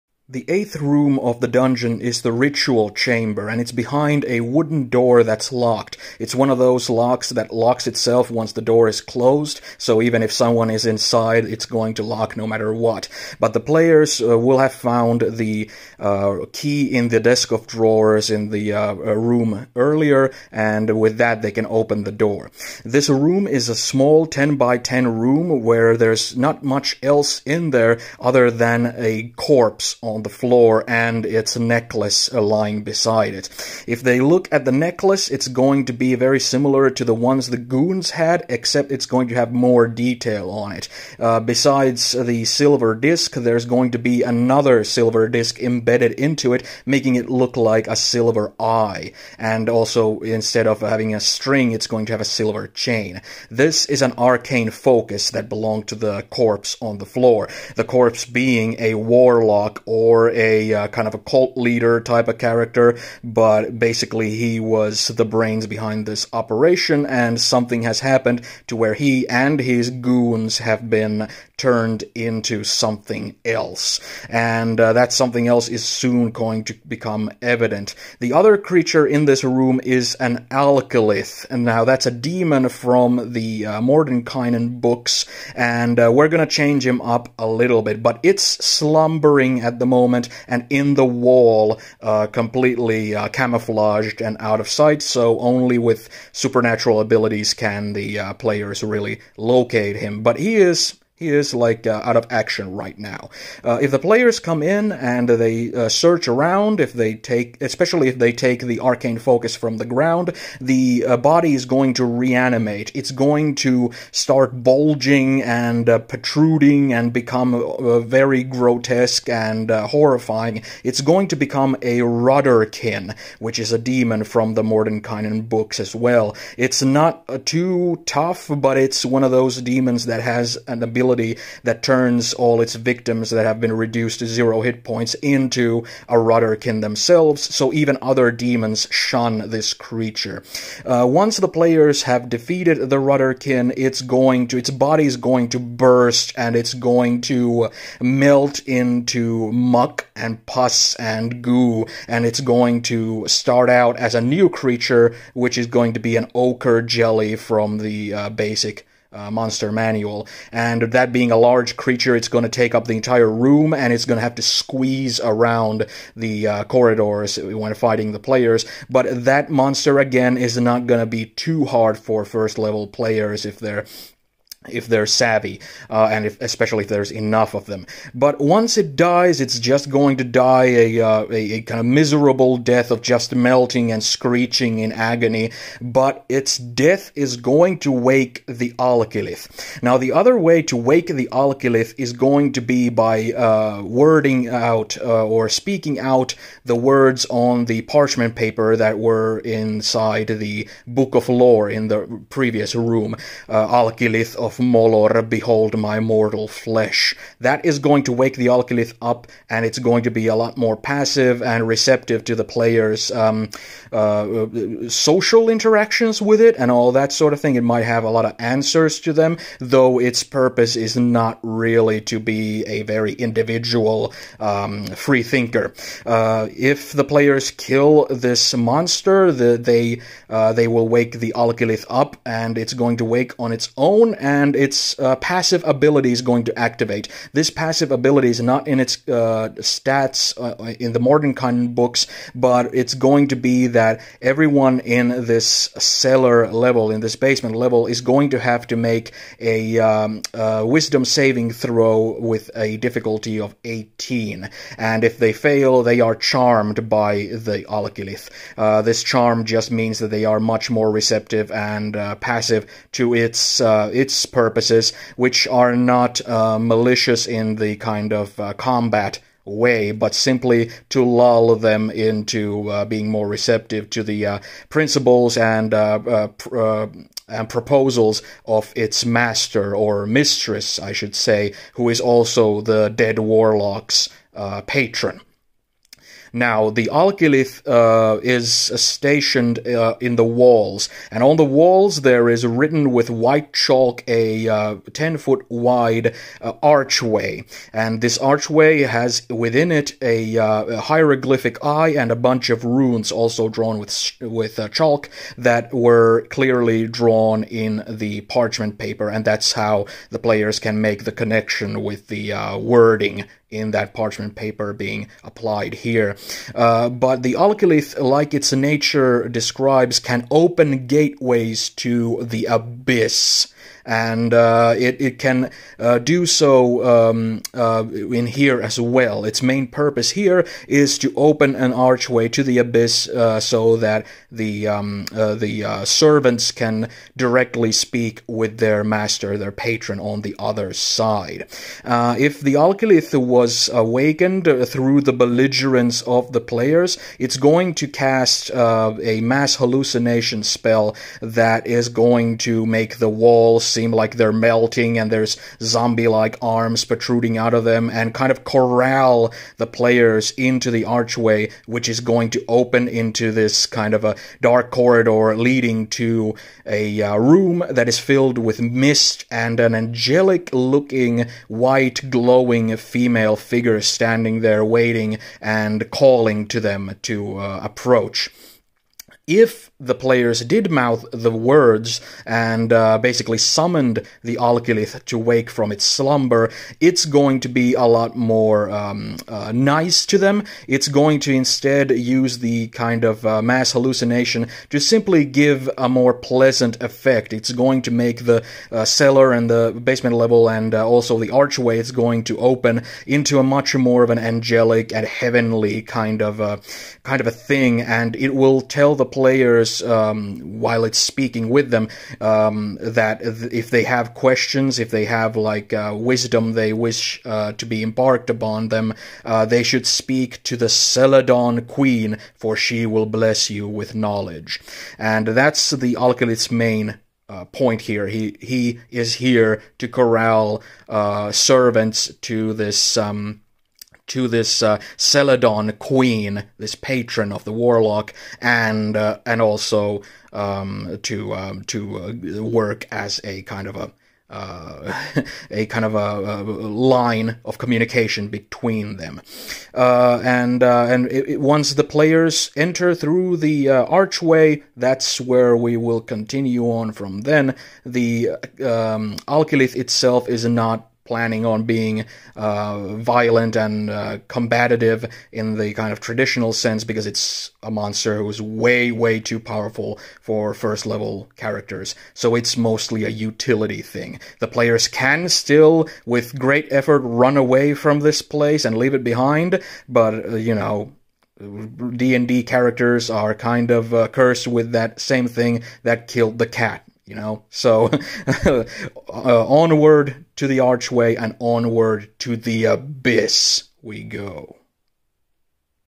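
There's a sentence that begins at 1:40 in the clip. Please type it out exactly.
But he is he is like uh, out of action right now.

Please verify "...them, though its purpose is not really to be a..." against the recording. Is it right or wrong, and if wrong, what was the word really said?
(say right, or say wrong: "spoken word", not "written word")
right.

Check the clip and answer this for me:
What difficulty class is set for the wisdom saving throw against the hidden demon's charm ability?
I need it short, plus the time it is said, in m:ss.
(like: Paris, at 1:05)
18, at 4:13.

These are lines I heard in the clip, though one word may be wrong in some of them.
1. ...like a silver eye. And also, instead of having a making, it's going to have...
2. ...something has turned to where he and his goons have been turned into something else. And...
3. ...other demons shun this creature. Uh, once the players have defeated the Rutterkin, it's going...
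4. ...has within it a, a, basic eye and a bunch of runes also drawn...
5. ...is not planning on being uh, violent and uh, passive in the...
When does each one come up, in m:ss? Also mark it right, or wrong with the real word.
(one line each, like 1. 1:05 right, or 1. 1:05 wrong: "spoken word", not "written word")
1. 0:47 wrong: "string", not "making"
2. 1:07 wrong: "happened", not "turned"
3. 2:18 right
4. 4:58 wrong: "hieroglyphic", not "basic"
5. 7:40 wrong: "combative", not "passive".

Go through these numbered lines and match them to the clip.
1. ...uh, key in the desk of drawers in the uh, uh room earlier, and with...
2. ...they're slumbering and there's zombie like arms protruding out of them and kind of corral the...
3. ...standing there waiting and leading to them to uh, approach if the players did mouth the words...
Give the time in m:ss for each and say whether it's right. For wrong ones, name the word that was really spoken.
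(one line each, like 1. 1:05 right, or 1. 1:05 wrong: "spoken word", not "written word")
1. 0:15 right
2. 5:54 wrong: "melting", not "slumbering"
3. 6:13 wrong: "calling", not "leading".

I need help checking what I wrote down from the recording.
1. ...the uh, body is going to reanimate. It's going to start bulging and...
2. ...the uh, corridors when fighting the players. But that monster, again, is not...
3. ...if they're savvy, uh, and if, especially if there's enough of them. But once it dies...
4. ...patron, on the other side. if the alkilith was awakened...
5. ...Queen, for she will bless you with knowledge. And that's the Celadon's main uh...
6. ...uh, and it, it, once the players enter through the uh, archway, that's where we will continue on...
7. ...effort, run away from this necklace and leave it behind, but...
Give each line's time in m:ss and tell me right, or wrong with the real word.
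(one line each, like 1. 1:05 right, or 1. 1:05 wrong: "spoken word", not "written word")
1. 1:50 right
2. 2:46 right
3. 2:54 right
4. 5:39 right
5. 7:01 wrong: "Alkilith", not "Celadon"
6. 7:30 right
7. 7:56 wrong: "place", not "necklace".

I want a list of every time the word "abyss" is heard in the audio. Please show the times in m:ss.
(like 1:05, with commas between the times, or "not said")
5:22, 5:32, 8:12.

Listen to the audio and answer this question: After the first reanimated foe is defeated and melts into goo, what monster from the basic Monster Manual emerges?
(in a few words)
ochre jelly.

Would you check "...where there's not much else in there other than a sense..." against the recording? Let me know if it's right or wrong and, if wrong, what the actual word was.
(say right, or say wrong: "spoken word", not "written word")
wrong: "corpse", not "sense".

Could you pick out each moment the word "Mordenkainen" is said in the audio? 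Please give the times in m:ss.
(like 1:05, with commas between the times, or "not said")
1:23, 2:04.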